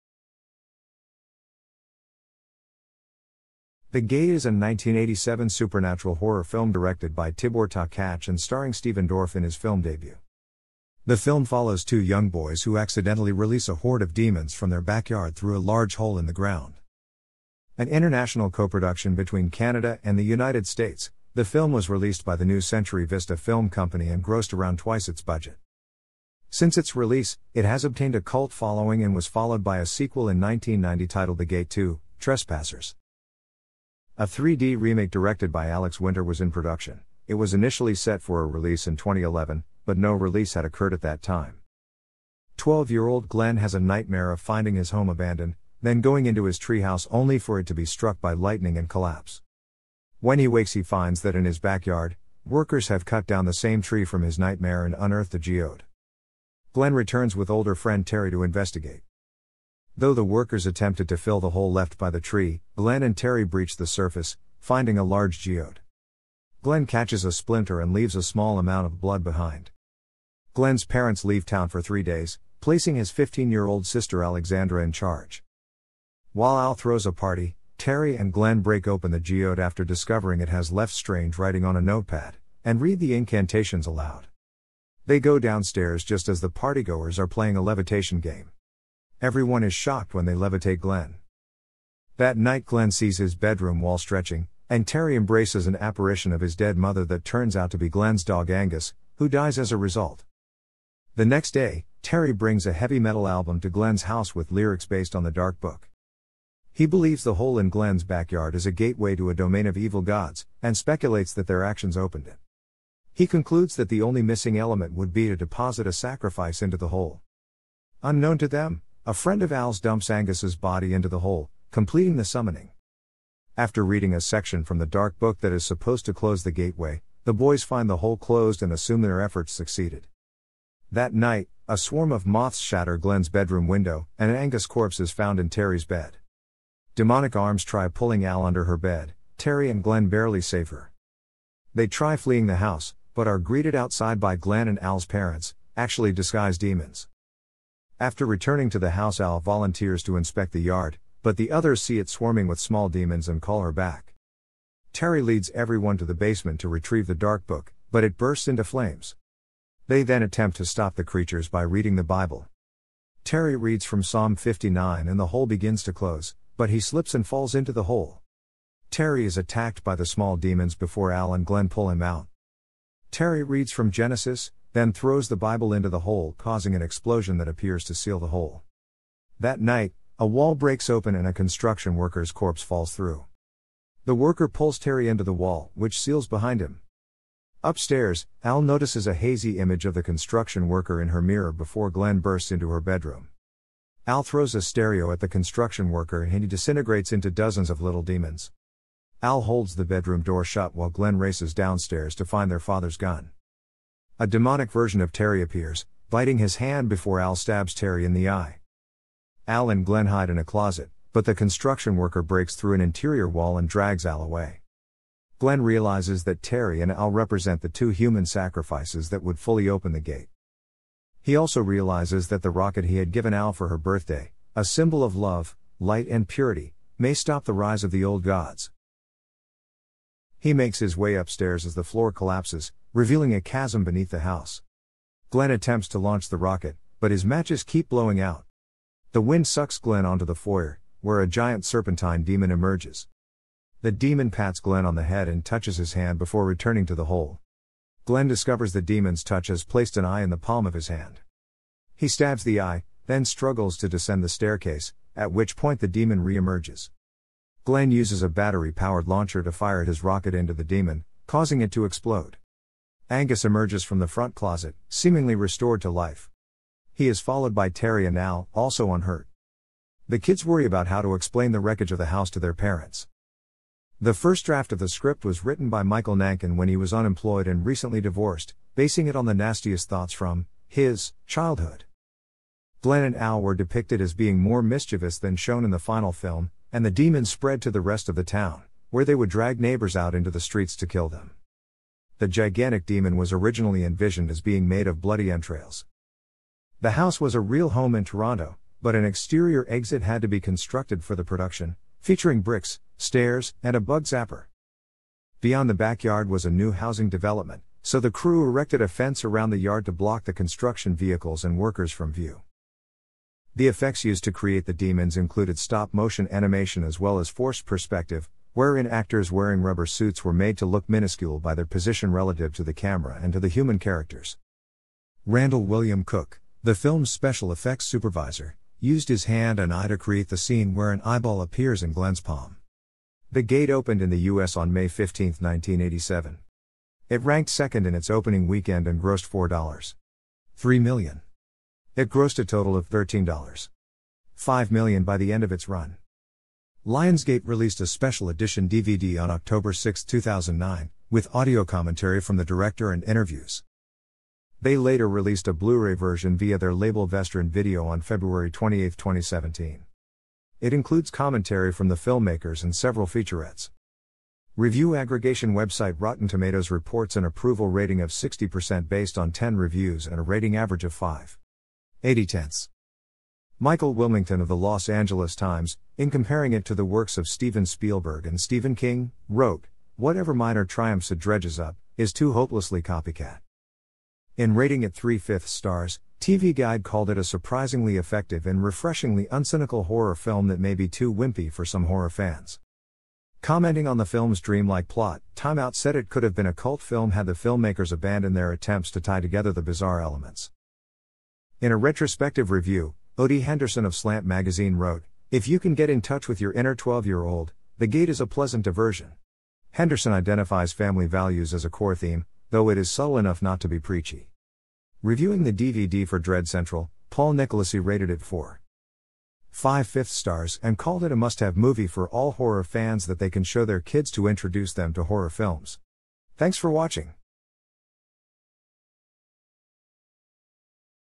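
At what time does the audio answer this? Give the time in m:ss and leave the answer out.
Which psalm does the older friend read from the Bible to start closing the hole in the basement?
2:44.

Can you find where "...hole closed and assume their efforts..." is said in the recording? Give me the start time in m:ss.
2:07.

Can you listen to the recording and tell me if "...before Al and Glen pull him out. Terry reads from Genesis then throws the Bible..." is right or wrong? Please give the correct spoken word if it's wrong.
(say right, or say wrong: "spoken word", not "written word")
right.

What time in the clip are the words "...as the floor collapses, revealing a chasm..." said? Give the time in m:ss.
3:51.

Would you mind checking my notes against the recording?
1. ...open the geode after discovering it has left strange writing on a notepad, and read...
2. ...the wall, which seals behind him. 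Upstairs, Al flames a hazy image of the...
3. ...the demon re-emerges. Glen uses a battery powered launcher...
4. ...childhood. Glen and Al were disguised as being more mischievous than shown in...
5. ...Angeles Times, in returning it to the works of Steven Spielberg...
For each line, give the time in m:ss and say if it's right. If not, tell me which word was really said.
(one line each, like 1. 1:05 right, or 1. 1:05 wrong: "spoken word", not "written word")
1. 1:18 right
2. 3:05 wrong: "notices", not "flames"
3. 4:15 right
4. 4:41 wrong: "depicted", not "disguised"
5. 6:14 wrong: "comparing", not "returning".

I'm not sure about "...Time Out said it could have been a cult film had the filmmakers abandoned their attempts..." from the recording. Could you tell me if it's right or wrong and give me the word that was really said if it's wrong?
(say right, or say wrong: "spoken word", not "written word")
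right.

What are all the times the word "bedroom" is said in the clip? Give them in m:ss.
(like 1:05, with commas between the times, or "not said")
1:33, 2:13, 3:12, 3:19.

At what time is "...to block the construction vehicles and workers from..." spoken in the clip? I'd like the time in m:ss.
5:09.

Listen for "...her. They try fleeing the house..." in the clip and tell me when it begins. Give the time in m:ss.
2:20.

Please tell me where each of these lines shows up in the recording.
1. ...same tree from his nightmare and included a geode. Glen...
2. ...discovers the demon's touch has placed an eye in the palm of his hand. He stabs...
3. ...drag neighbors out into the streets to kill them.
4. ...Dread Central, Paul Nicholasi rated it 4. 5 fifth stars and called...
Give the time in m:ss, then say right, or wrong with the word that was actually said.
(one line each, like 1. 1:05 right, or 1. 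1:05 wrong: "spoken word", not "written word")
1. 0:53 wrong: "unearthed", not "included"
2. 4:08 right
3. 4:49 right
4. 6:56 right.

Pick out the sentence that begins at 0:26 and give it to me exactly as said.
Since its release, it has obtained a cult following and was followed by a sequel in 1990 titled The Gate 2 Trespassers.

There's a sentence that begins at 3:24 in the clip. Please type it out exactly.
A demonic version of Terry appears, biting his hand before Al stabs Terry in the eye.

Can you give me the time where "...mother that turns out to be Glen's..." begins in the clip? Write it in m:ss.
1:36.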